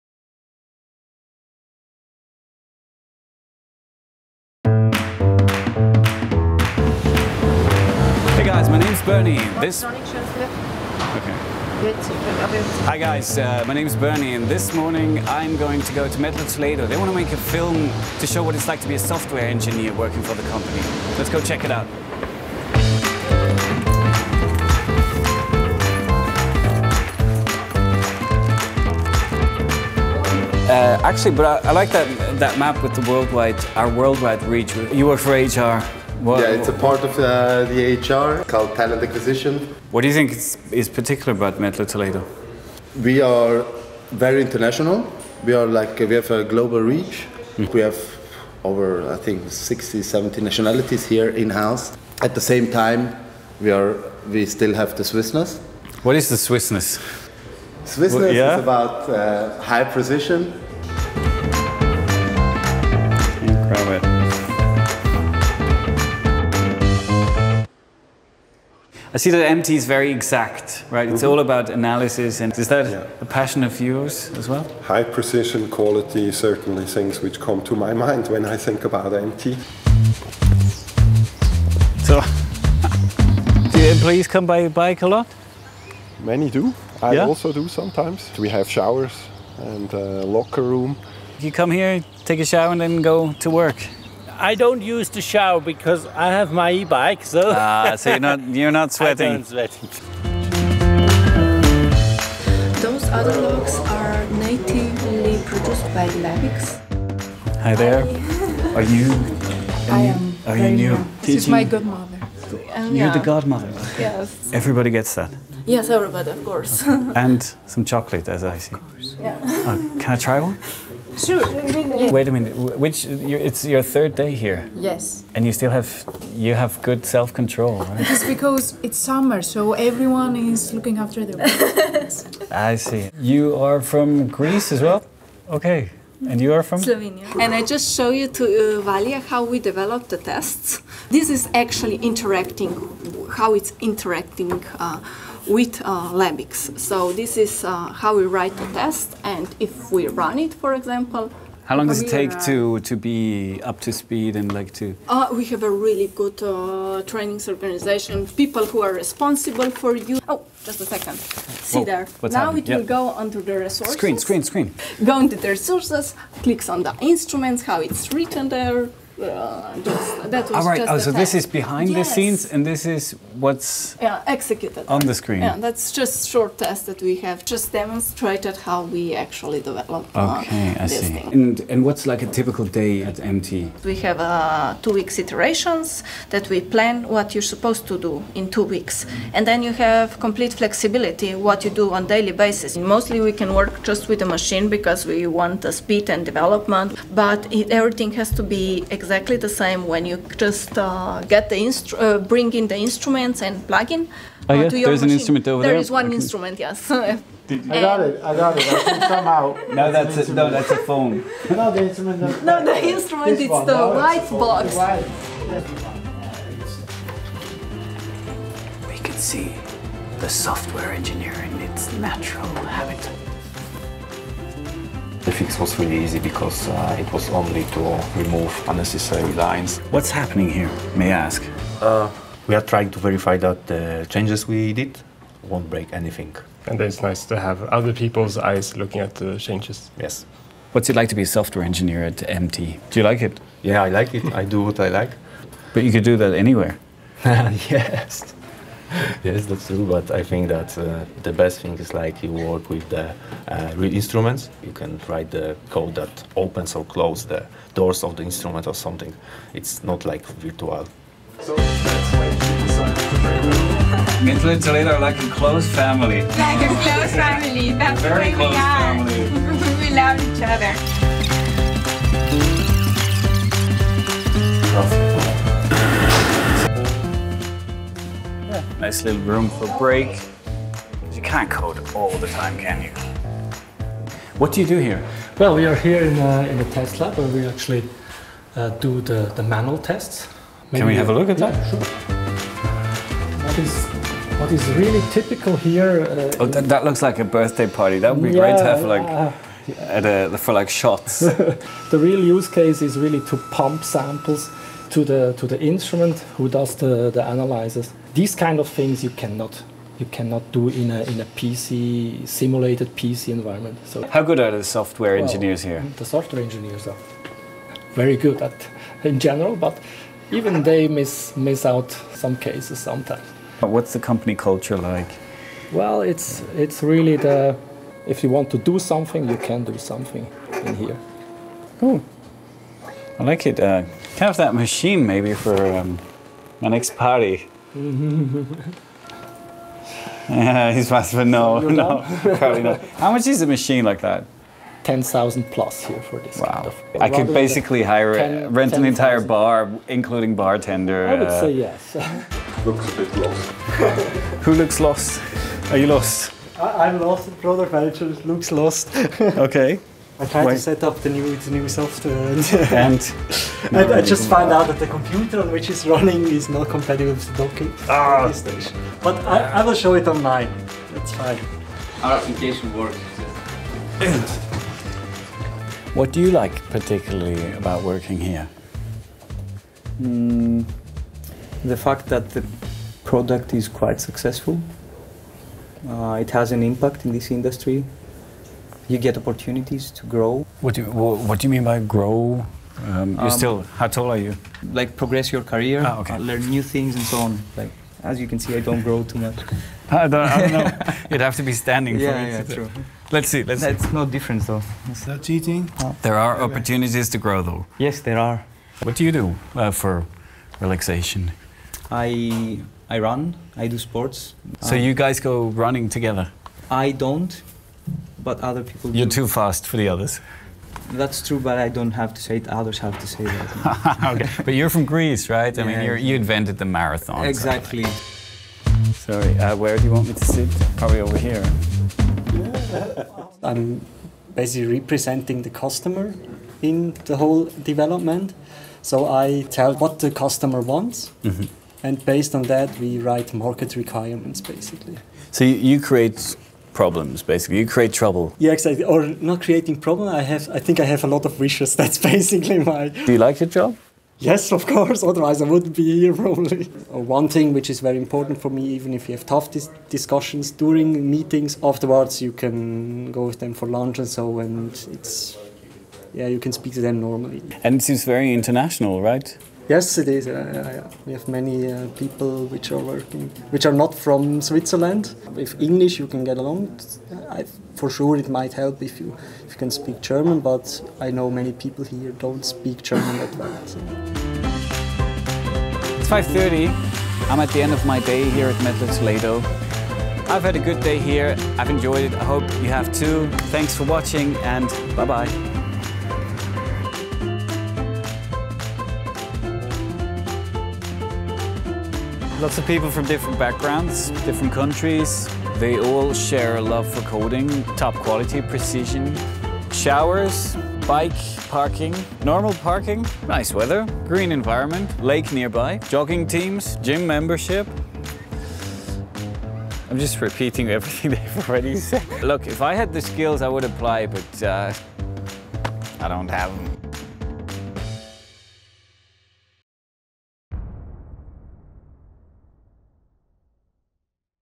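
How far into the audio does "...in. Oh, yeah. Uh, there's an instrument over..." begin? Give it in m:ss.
3:23.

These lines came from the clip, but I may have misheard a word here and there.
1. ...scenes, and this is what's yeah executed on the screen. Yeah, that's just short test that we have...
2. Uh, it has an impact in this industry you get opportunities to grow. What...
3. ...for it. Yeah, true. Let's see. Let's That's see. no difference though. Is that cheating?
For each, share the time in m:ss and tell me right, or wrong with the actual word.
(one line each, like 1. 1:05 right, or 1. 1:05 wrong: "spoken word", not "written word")
1. 2:52 right
2. 6:25 right
3. 6:42 right.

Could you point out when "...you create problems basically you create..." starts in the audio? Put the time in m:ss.
7:25.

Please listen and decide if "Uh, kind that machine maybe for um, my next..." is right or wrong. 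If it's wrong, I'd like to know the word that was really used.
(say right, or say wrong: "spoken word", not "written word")
right.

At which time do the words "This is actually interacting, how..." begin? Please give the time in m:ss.
2:21.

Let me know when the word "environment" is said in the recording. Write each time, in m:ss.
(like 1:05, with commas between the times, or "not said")
5:13, 8:34.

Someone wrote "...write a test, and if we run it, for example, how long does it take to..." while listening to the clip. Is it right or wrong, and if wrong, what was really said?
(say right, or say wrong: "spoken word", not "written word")
right.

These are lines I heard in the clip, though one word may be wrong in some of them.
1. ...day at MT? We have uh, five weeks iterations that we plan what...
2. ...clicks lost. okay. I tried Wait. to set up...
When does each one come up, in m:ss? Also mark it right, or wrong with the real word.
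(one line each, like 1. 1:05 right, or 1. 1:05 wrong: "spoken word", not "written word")
1. 3:02 wrong: "two", not "five"
2. 5:58 wrong: "looks", not "clicks".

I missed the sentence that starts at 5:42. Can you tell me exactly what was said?
How much is a machine like that?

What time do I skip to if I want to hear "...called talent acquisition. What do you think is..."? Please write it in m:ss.
0:38.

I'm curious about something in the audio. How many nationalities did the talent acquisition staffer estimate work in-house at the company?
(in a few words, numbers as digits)
60 to 70.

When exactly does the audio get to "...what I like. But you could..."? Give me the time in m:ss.
4:04.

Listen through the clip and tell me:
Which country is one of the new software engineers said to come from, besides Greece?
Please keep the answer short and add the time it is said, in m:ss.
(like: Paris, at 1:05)
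Slovenia, at 2:16.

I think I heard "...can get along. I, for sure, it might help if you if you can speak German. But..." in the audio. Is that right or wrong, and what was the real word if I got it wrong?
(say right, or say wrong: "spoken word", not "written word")
right.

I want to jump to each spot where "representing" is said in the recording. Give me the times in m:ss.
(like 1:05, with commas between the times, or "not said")
7:14.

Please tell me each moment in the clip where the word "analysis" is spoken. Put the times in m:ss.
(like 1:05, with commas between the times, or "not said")
1:11, 5:07.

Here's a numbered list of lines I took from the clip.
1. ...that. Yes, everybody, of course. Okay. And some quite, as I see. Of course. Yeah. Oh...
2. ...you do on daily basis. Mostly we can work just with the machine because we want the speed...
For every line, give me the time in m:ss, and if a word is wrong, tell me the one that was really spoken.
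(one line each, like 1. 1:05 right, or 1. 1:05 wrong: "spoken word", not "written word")
1. 1:55 wrong: "chocolate", not "quite"
2. 3:11 right.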